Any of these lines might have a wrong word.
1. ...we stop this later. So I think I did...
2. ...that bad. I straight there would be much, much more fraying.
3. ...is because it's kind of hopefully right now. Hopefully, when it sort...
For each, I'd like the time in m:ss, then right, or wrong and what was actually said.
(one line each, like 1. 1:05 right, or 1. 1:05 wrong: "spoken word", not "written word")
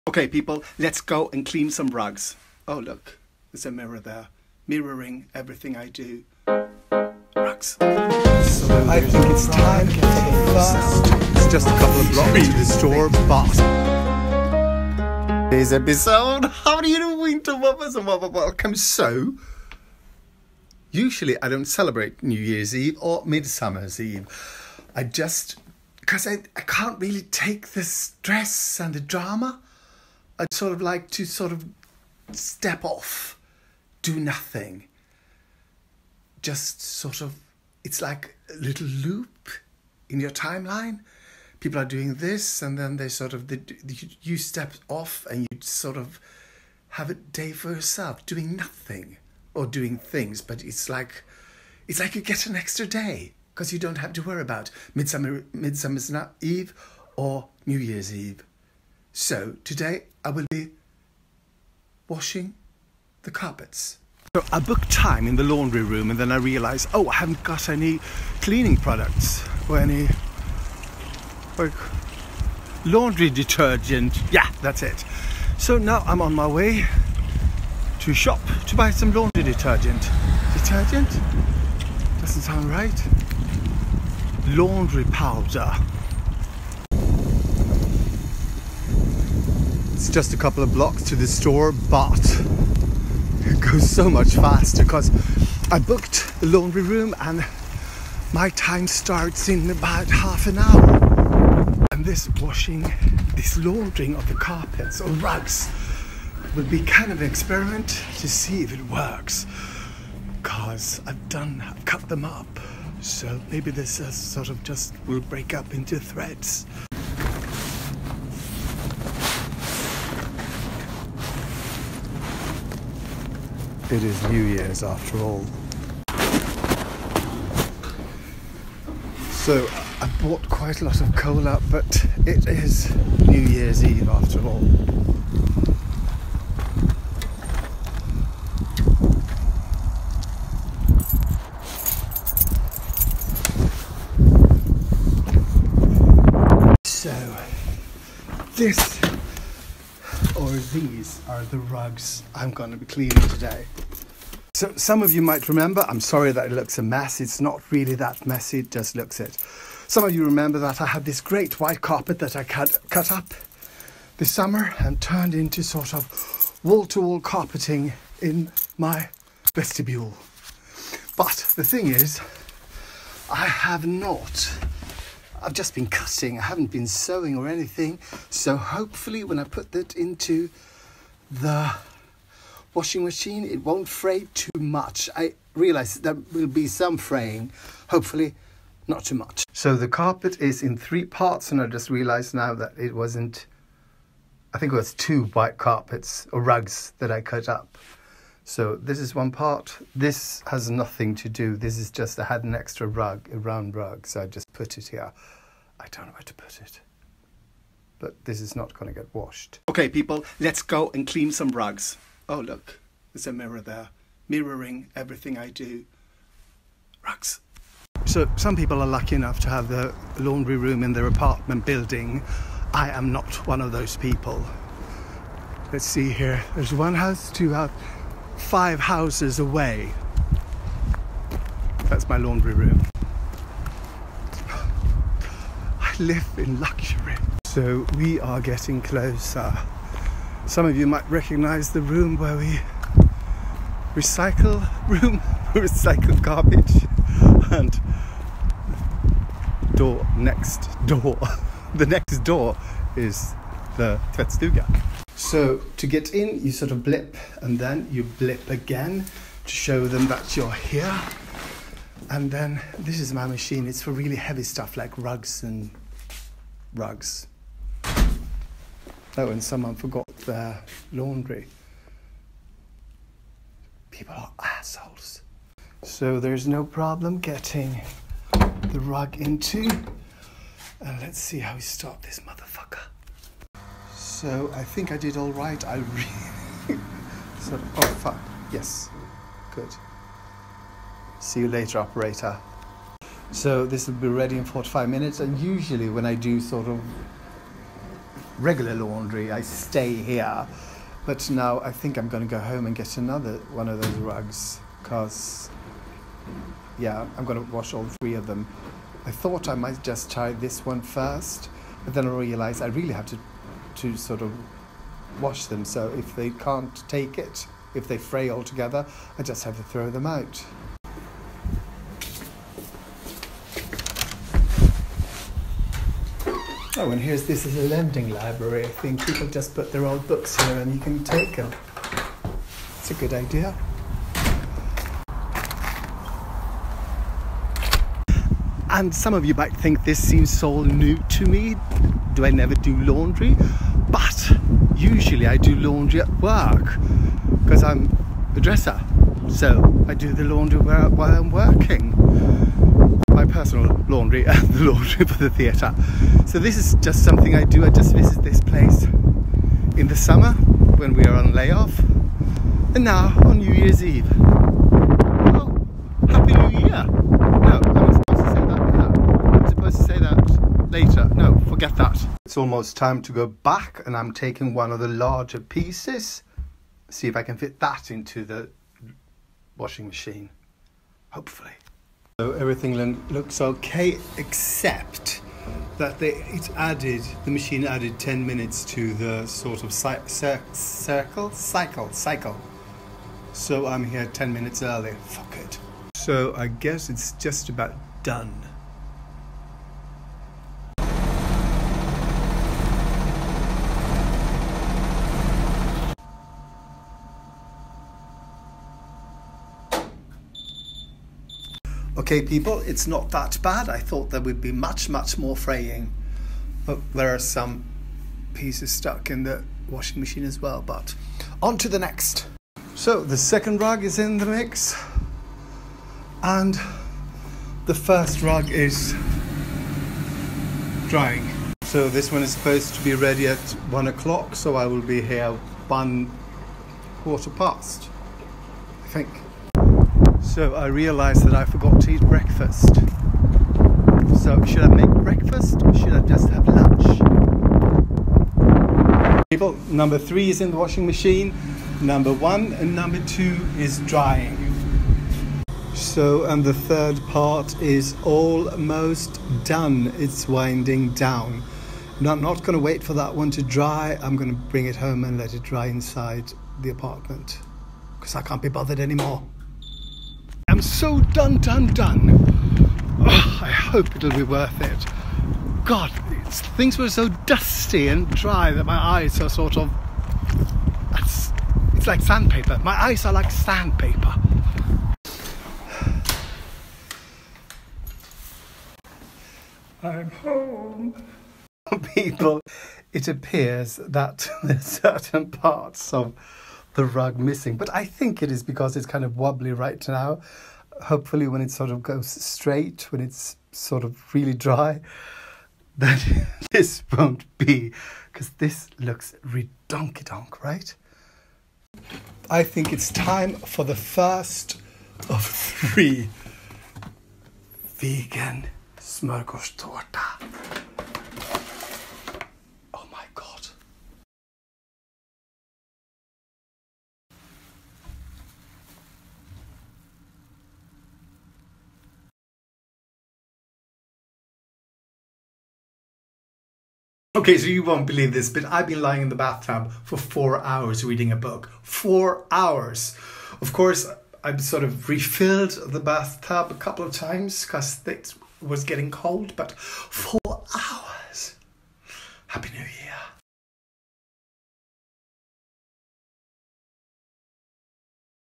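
1. 4:41 wrong: "motherfucker", not "later"
2. 6:53 wrong: "thought", not "straight"
3. 8:18 wrong: "wobbly", not "hopefully".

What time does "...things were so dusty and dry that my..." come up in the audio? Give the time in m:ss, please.
7:56.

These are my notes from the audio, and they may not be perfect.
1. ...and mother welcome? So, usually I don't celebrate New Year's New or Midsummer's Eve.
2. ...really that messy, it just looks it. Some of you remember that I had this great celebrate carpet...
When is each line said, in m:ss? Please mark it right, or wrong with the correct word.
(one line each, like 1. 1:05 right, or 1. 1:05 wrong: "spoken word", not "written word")
1. 0:17 wrong: "Eve", not "New"
2. 2:37 wrong: "white", not "celebrate".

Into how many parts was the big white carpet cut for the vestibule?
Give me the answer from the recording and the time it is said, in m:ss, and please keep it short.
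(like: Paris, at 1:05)
3, at 3:10.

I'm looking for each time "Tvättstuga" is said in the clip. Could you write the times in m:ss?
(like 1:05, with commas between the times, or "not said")
4:14.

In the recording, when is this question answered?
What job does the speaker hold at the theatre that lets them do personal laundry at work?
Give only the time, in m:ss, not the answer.
5:48.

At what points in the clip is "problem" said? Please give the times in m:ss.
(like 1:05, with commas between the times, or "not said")
4:36.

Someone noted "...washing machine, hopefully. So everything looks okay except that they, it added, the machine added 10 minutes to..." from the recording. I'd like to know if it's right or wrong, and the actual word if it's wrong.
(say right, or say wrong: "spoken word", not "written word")
right.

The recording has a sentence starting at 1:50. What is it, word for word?
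Because I've done, I've cut them up.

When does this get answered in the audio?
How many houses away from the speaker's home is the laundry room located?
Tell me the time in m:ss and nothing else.
3:48.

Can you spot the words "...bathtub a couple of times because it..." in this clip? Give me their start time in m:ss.
9:05.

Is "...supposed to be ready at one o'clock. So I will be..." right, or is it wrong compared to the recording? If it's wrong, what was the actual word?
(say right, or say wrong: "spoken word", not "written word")
right.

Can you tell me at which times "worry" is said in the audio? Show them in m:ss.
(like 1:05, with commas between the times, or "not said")
0:54.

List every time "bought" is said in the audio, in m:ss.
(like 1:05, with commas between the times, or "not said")
2:10.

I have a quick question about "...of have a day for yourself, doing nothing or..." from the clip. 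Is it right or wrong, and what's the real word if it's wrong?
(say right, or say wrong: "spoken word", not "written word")
right.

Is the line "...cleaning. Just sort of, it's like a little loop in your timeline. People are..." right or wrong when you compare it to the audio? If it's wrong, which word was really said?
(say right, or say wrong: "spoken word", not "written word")
wrong: "nothing", not "cleaning".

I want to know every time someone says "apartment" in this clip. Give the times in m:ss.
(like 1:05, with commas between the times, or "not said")
3:41, 7:46.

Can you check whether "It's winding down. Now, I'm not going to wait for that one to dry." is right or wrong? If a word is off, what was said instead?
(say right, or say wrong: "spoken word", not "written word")
right.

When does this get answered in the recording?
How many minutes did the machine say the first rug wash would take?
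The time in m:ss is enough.
4:54.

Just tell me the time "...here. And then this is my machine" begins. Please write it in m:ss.
4:20.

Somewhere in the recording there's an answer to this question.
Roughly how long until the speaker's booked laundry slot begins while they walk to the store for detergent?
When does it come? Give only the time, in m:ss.
1:40.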